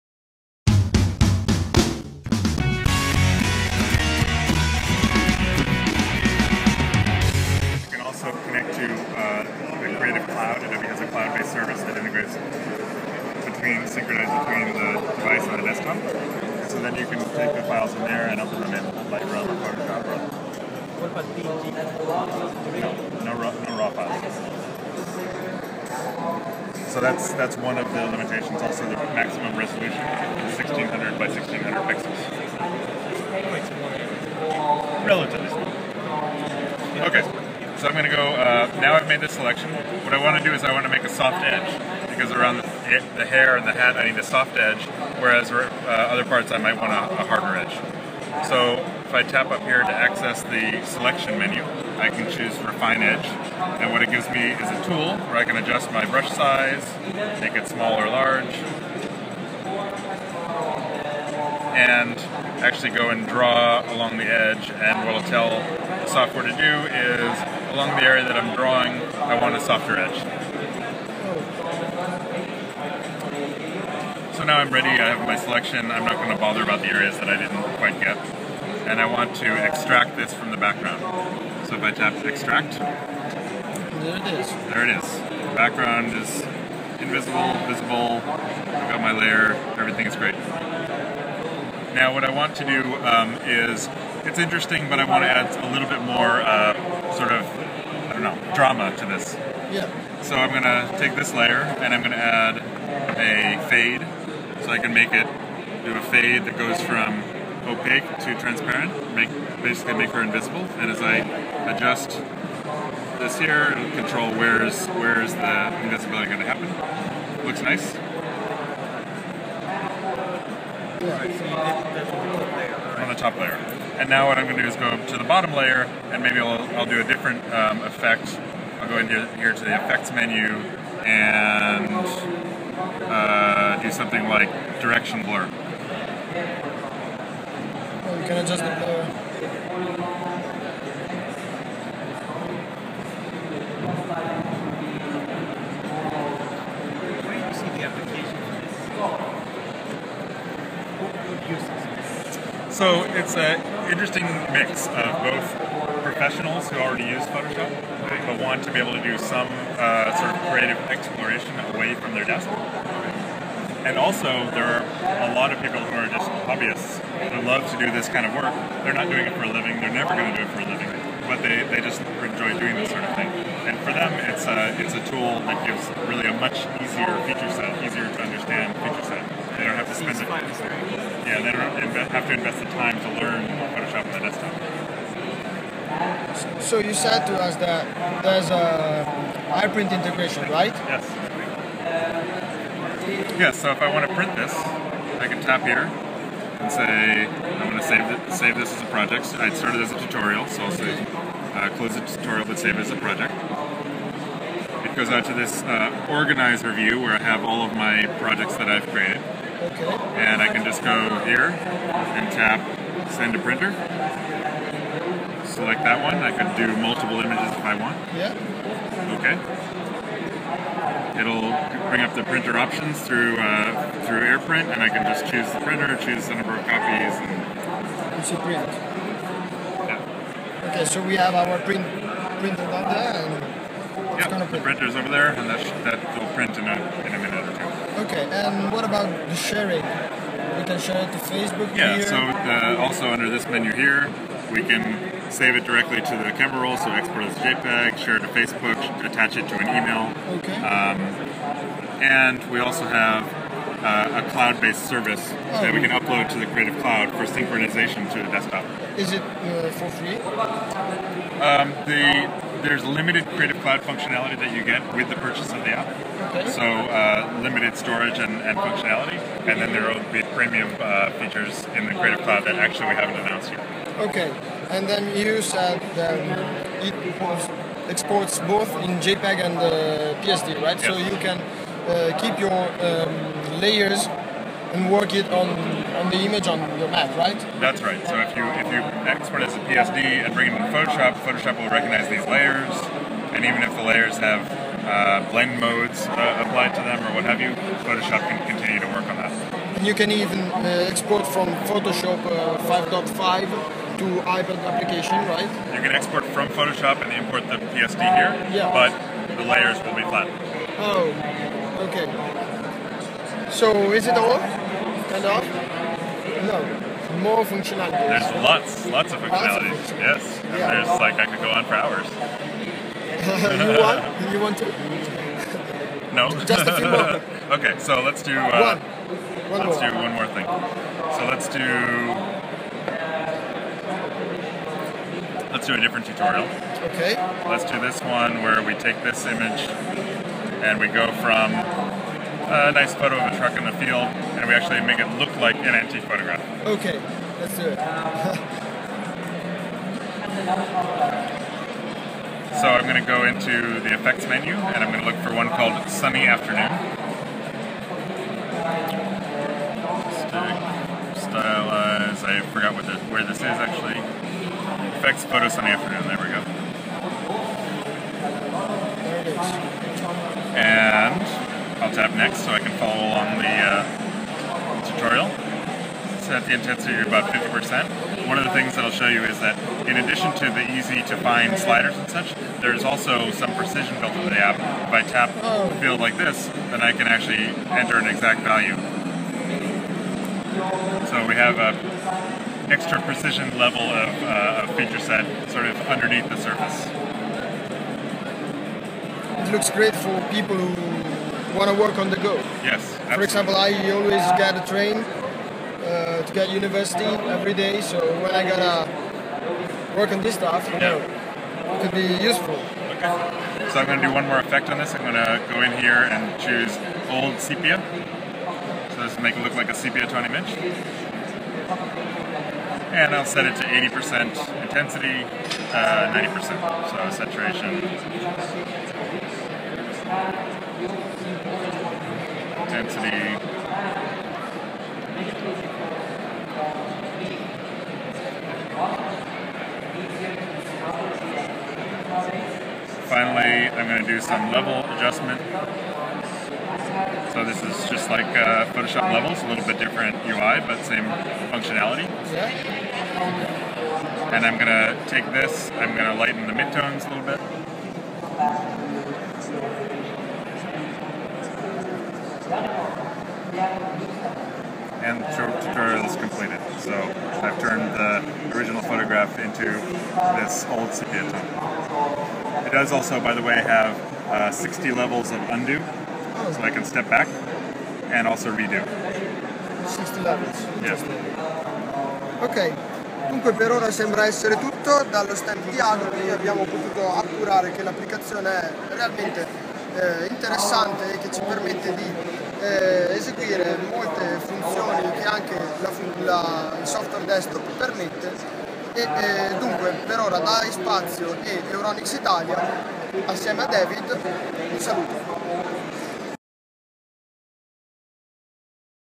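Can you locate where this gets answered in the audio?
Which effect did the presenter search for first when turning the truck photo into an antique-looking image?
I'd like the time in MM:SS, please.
05:55.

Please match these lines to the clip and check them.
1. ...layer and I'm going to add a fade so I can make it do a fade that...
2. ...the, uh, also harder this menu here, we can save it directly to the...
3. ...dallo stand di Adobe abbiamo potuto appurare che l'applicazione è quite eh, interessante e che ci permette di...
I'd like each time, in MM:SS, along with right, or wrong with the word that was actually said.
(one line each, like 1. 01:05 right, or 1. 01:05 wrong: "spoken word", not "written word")
1. 01:41 right
2. 04:02 wrong: "under", not "harder"
3. 08:05 wrong: "realmente", not "quite".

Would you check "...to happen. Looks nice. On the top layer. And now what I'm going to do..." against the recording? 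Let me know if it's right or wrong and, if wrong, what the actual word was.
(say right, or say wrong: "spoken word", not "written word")
right.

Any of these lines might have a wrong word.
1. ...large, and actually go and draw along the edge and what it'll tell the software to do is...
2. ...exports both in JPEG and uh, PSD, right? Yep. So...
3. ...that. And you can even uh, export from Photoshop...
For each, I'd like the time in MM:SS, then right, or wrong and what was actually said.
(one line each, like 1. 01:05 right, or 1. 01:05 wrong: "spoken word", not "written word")
1. 00:58 right
2. 04:37 right
3. 04:59 right.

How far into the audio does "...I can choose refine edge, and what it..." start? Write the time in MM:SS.
00:51.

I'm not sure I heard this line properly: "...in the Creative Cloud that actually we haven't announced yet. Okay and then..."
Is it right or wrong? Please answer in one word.
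right.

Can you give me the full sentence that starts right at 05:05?
You can export from Photoshop and import the PSD here, yeah.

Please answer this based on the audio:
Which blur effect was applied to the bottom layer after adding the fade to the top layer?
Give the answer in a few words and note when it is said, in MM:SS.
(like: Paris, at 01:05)
Direction blur, at 02:14.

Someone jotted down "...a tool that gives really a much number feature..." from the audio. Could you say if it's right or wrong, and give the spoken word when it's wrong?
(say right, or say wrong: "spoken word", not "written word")
wrong: "easier", not "number".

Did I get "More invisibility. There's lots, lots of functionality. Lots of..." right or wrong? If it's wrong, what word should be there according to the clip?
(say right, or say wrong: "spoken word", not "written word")
wrong: "functionality", not "invisibility".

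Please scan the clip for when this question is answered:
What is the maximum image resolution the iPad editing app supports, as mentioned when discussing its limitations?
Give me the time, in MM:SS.
00:30.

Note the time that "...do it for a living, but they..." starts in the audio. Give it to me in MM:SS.
02:50.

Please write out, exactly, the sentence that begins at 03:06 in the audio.
So you said to us that there's a AirPrint integration, right?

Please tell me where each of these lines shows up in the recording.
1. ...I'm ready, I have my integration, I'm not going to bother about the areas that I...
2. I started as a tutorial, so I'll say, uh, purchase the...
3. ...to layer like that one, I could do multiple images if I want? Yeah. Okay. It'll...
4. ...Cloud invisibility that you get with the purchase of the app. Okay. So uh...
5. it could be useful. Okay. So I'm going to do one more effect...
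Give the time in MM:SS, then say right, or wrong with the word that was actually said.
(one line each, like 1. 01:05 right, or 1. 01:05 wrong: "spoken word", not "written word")
1. 01:14 wrong: "selection", not "integration"
2. 03:19 wrong: "close", not "purchase"
3. 03:33 wrong: "printer", not "layer"
4. 04:23 wrong: "functionality", not "invisibility"
5. 06:51 right.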